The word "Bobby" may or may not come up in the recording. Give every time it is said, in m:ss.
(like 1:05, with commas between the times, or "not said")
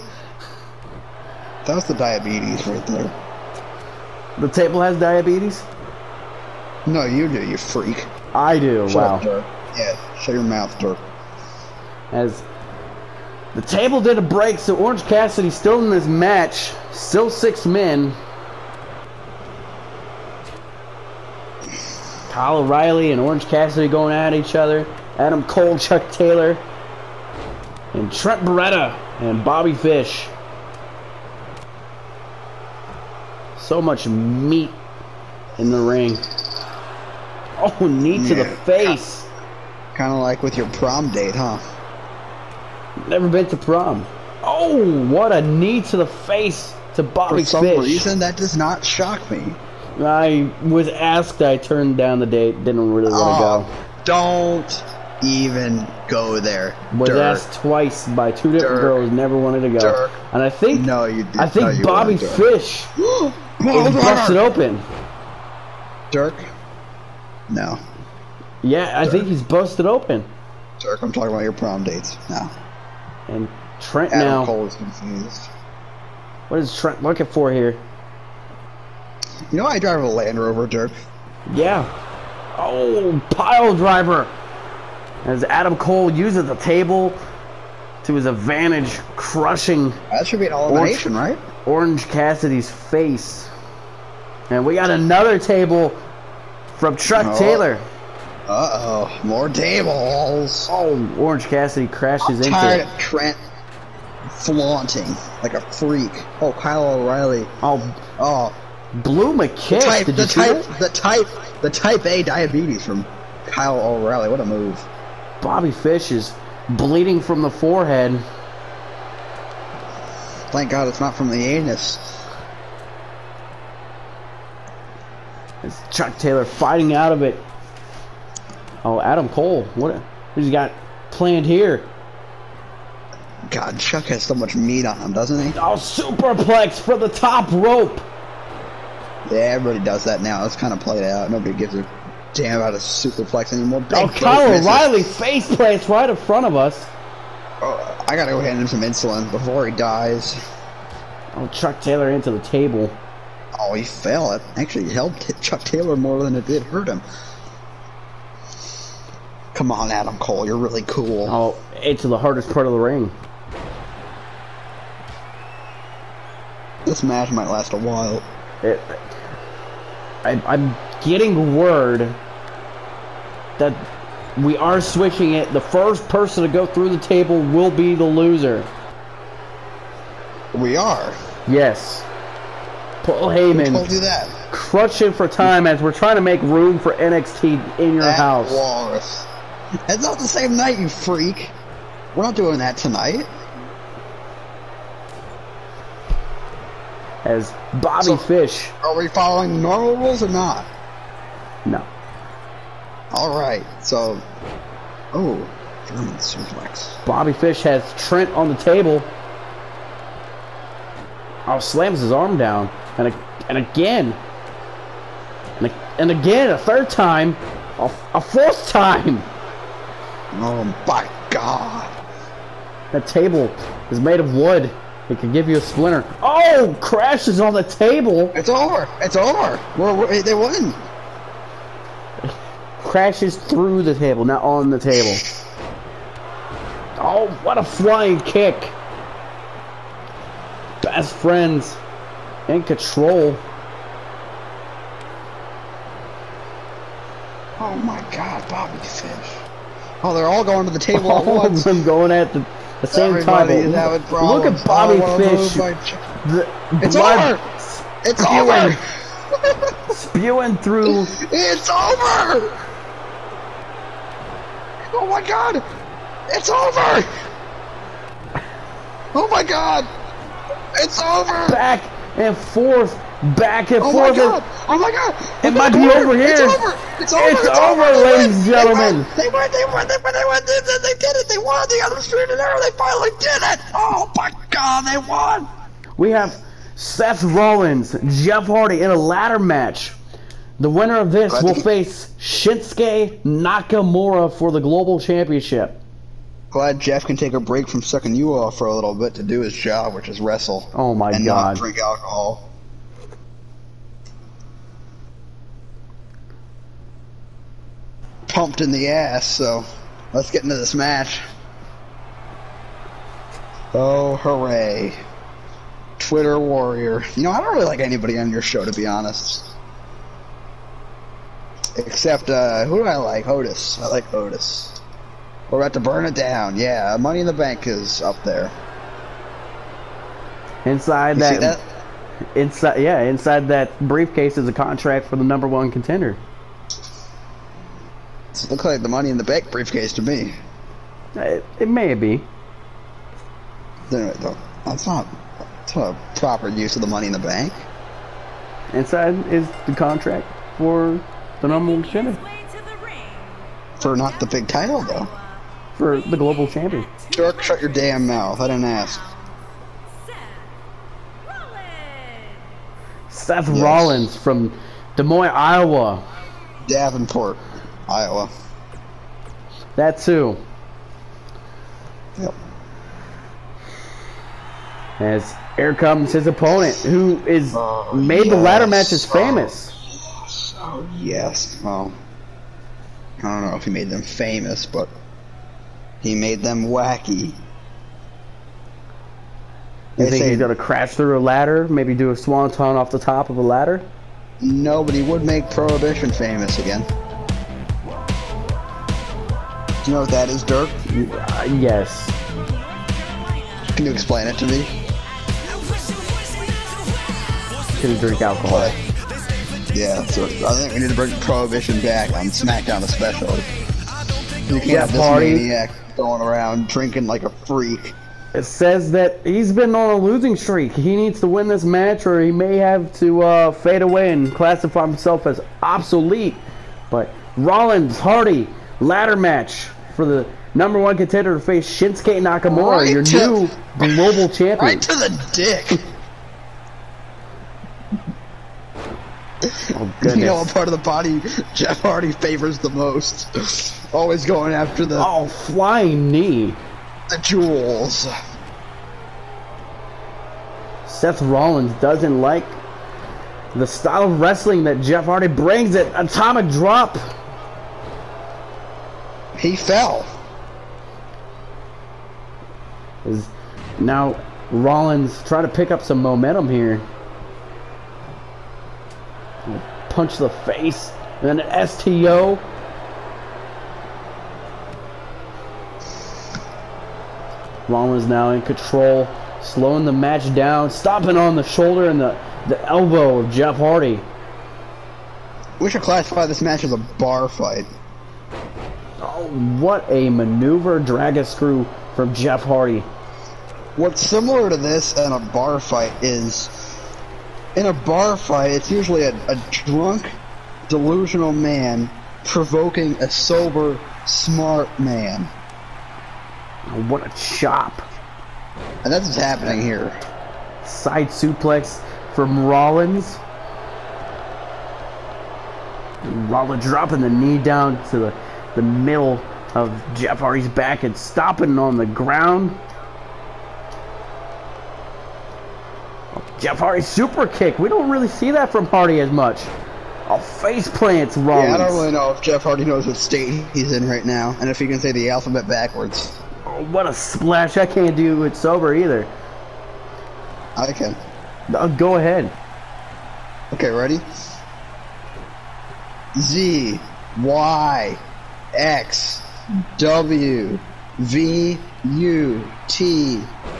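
0:29, 0:47, 1:01, 1:55, 3:17, 3:27, 4:08, 4:14.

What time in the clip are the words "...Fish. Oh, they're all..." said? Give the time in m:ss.
4:08.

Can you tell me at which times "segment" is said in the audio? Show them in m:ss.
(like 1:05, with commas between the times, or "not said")
not said.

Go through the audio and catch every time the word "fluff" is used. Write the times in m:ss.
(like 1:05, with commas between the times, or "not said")
not said.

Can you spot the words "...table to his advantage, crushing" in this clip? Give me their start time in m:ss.
1:26.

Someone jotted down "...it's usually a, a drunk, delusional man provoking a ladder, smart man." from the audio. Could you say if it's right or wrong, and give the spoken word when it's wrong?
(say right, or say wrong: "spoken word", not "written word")
wrong: "sober", not "ladder".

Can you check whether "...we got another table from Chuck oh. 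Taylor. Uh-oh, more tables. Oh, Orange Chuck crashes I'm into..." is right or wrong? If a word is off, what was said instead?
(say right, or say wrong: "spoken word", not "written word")
wrong: "Cassidy", not "Chuck".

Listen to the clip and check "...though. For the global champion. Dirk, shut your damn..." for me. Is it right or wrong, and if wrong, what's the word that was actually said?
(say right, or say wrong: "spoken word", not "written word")
right.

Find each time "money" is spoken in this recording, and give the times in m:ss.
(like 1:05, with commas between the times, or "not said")
5:27, 5:38, 5:46.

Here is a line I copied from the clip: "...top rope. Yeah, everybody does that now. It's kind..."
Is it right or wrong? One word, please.
right.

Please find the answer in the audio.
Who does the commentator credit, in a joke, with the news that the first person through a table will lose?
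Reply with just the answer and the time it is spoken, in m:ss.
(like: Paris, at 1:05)
Paul Heyman, at 3:03.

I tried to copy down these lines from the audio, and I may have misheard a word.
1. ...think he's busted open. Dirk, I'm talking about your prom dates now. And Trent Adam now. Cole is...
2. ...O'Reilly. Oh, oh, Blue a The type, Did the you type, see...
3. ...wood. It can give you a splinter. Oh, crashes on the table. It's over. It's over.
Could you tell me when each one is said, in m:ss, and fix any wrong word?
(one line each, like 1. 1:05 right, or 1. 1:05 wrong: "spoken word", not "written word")
1. 1:09 right
2. 1:47 right
3. 3:44 right.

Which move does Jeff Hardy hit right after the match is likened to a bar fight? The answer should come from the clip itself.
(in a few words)
Dragon screw.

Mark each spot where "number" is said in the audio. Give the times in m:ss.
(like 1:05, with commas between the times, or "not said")
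5:35, 5:51, 7:10.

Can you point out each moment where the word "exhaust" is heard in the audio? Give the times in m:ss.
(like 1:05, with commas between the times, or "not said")
not said.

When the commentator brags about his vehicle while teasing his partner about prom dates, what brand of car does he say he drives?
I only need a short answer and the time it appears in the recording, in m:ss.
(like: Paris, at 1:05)
Land Rover, at 1:20.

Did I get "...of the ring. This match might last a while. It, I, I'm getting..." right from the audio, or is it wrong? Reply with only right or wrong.
right.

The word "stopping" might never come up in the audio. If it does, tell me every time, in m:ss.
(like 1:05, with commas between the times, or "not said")
8:00, 8:40.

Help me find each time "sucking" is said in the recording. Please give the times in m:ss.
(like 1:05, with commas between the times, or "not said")
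4:57.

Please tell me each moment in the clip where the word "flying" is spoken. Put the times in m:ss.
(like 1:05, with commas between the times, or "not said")
3:57, 7:25.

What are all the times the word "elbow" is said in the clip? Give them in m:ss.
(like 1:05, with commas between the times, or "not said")
8:02.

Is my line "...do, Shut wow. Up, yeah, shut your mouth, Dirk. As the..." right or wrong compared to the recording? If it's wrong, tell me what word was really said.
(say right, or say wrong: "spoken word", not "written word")
right.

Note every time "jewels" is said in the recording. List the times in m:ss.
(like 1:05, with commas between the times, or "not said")
7:27.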